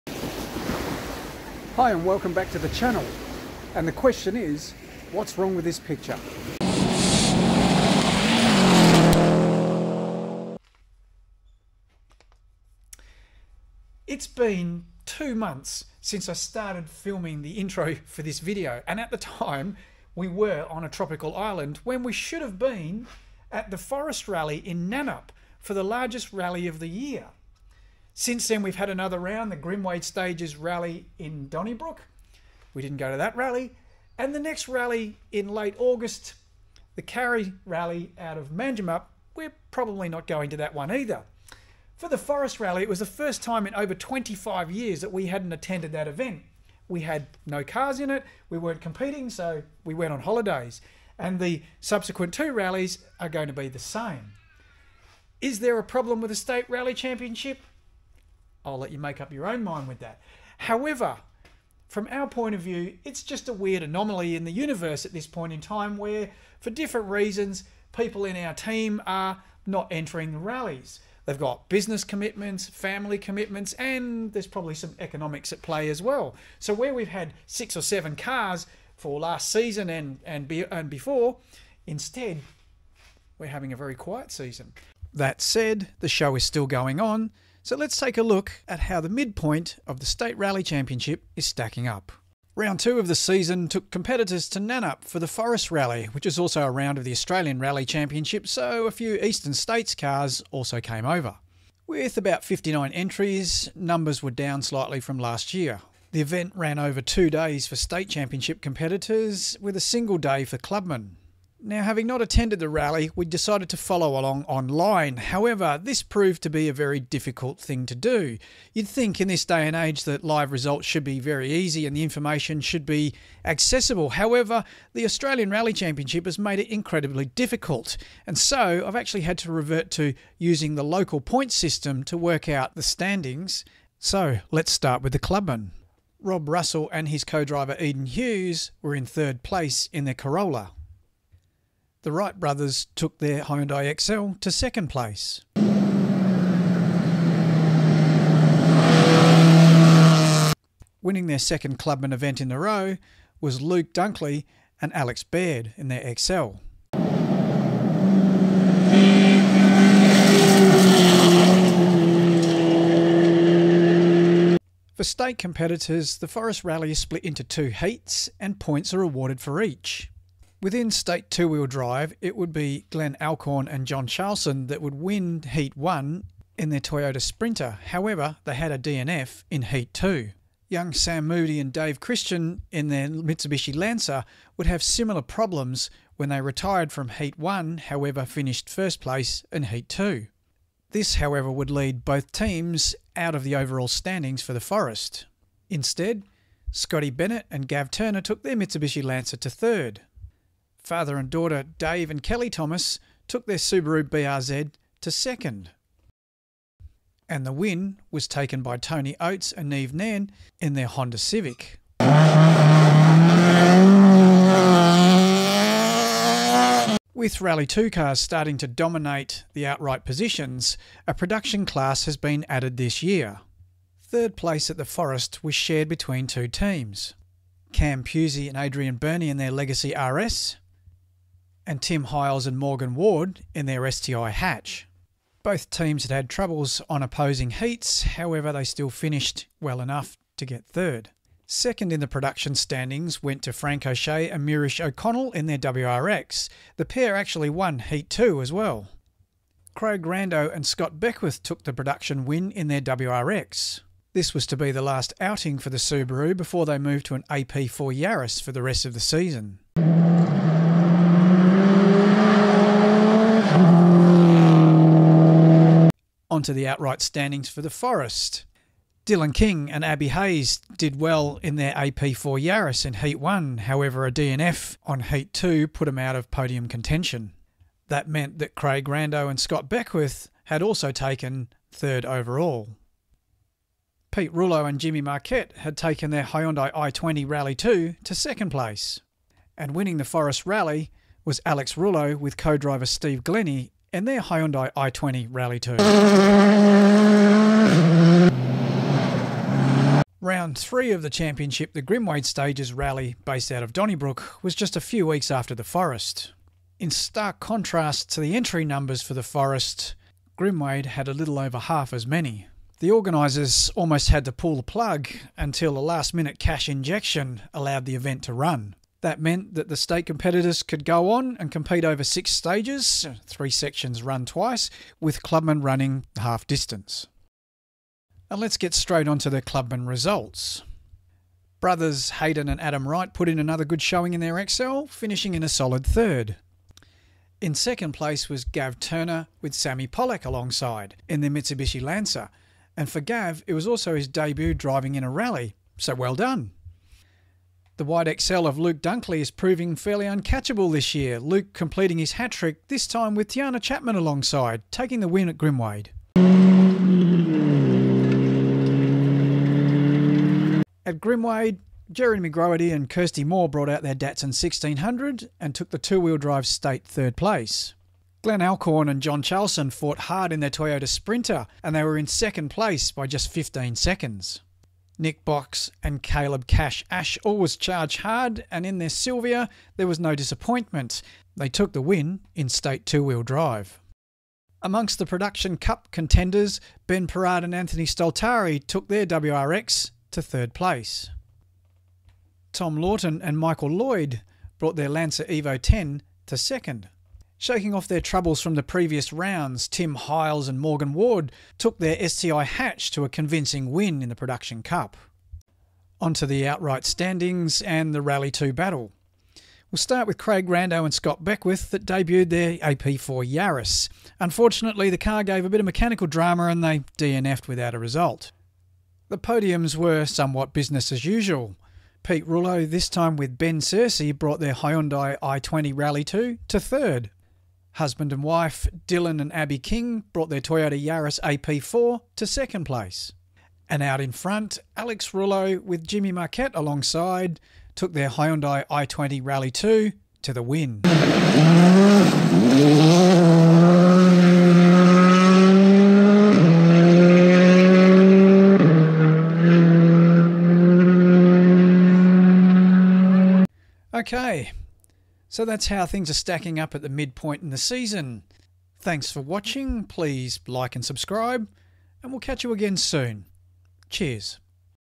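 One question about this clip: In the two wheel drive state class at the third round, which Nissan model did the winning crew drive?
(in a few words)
Silvia.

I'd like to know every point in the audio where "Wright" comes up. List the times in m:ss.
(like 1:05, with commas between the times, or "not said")
2:22, 5:32.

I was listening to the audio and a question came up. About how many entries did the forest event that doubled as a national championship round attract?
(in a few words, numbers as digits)
59.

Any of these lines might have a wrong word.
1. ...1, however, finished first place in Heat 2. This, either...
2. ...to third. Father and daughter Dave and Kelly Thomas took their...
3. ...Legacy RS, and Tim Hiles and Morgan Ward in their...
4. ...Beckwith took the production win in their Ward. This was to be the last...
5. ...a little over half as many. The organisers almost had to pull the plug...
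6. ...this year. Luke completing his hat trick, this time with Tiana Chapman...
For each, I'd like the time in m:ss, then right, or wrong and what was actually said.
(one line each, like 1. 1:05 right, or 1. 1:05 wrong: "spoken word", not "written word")
1. 3:07 wrong: "however", not "either"
2. 3:19 right
3. 3:49 right
4. 4:10 wrong: "WRX", not "Ward"
5. 5:11 right
6. 5:50 right.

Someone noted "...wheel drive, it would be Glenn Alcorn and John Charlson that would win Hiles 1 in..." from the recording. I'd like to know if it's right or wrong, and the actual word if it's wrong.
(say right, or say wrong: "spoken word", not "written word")
wrong: "Heat", not "Hiles".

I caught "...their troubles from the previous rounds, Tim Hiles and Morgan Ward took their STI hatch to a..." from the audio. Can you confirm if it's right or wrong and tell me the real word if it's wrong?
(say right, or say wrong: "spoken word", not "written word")
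right.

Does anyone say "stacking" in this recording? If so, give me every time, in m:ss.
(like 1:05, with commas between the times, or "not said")
1:31, 7:36.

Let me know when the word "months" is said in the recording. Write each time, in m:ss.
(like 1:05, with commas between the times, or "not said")
0:15.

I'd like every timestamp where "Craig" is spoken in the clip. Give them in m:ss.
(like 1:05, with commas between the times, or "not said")
4:09, 4:38, 6:50.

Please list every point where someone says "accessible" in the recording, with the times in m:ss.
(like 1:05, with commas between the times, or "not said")
2:03.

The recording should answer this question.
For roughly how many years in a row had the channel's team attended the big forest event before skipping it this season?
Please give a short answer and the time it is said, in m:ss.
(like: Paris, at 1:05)
25, at 0:43.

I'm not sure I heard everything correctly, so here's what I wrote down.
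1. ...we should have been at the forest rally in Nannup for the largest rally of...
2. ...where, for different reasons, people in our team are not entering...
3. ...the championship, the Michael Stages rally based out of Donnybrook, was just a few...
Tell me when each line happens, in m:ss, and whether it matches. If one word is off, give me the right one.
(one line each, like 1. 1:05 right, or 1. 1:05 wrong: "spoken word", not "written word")
1. 0:22 right
2. 1:05 right
3. 5:01 wrong: "Grimwade", not "Michael".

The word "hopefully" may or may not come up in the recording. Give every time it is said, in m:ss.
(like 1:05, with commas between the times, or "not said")
not said.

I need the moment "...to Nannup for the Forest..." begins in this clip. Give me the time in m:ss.
1:34.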